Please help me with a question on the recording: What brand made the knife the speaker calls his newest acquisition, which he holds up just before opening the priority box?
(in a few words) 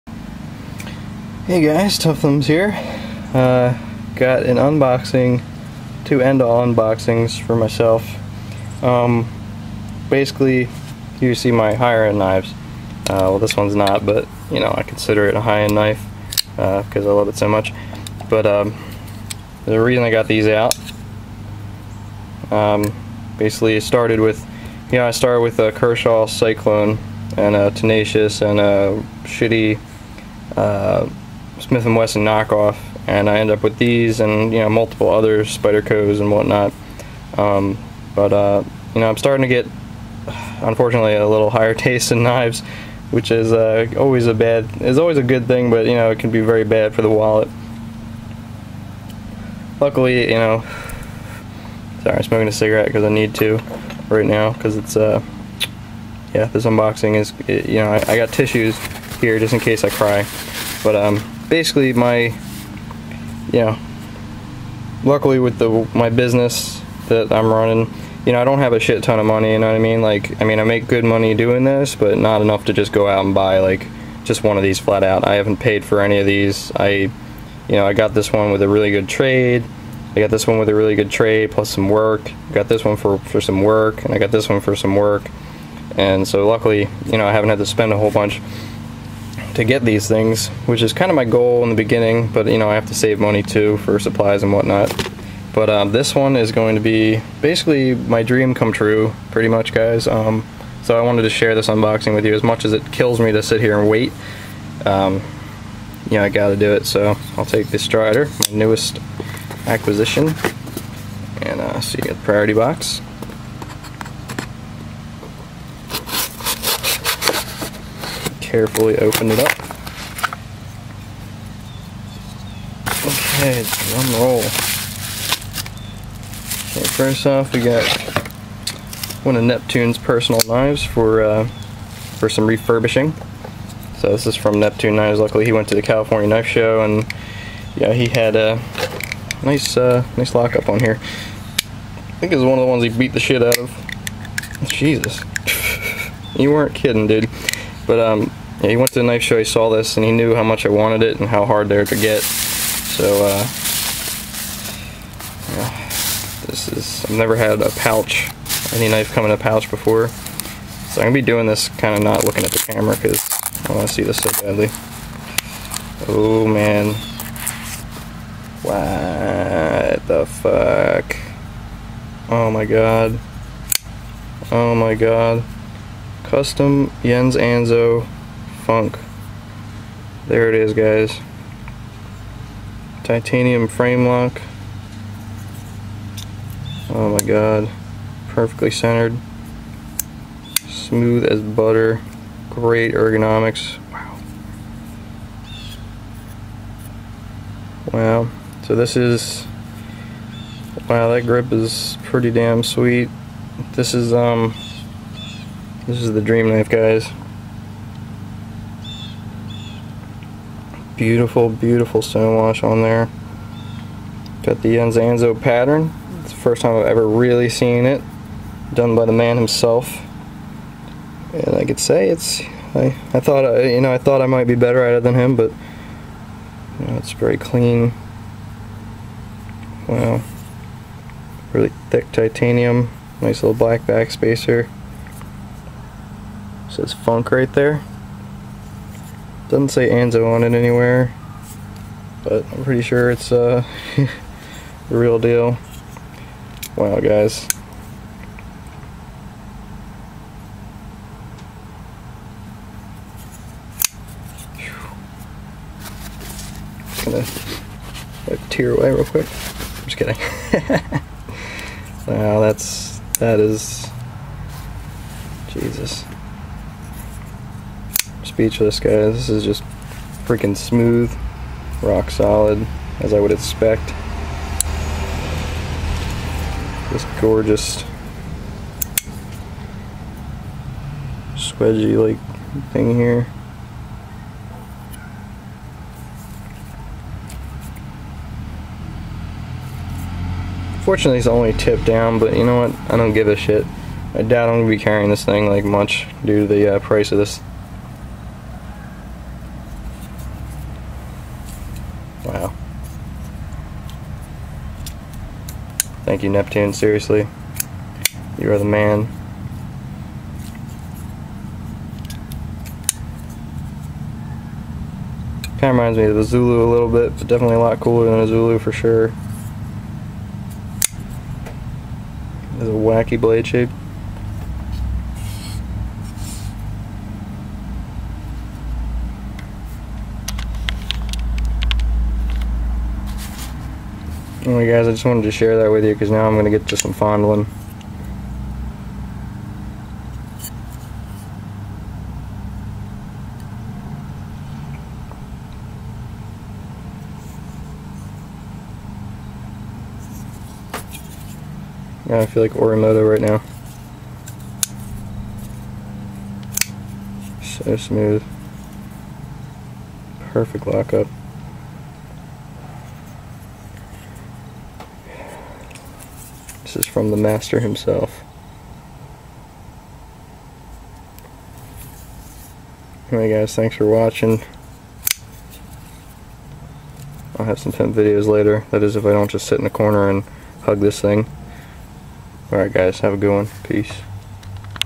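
Strider.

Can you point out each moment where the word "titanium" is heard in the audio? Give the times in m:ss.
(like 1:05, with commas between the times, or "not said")
3:03, 3:52.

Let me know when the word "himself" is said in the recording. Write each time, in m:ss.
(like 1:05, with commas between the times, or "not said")
3:39, 6:07.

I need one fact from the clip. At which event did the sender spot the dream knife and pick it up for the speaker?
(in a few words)
California Knife Show.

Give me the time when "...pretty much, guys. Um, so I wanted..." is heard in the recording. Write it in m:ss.
1:39.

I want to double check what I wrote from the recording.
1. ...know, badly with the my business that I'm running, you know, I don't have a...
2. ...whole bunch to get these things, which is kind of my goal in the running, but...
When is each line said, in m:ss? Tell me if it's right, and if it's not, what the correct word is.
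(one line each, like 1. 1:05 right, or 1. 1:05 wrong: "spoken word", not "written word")
1. 1:03 wrong: "luckily", not "badly"
2. 1:27 wrong: "beginning", not "running".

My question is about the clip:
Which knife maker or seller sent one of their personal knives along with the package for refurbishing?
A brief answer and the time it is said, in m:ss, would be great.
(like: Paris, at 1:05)
Neptune Knives, at 2:14.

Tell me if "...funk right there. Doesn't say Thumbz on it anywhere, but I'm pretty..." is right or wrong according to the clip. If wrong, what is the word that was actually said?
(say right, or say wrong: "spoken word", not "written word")
wrong: "Anso", not "Thumbz".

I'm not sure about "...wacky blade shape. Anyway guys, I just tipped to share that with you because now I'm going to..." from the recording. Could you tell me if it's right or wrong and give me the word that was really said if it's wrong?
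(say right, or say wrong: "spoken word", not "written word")
wrong: "wanted", not "tipped".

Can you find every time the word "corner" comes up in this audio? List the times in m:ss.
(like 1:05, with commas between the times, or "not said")
6:19.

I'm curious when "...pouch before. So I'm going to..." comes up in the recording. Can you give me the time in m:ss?
2:39.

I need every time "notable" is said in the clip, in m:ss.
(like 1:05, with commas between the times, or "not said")
not said.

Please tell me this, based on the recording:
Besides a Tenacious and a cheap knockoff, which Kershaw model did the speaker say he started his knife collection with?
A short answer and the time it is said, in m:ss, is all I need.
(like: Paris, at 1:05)
Kershaw Cyclone, at 0:25.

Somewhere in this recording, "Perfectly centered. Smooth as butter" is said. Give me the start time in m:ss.
3:08.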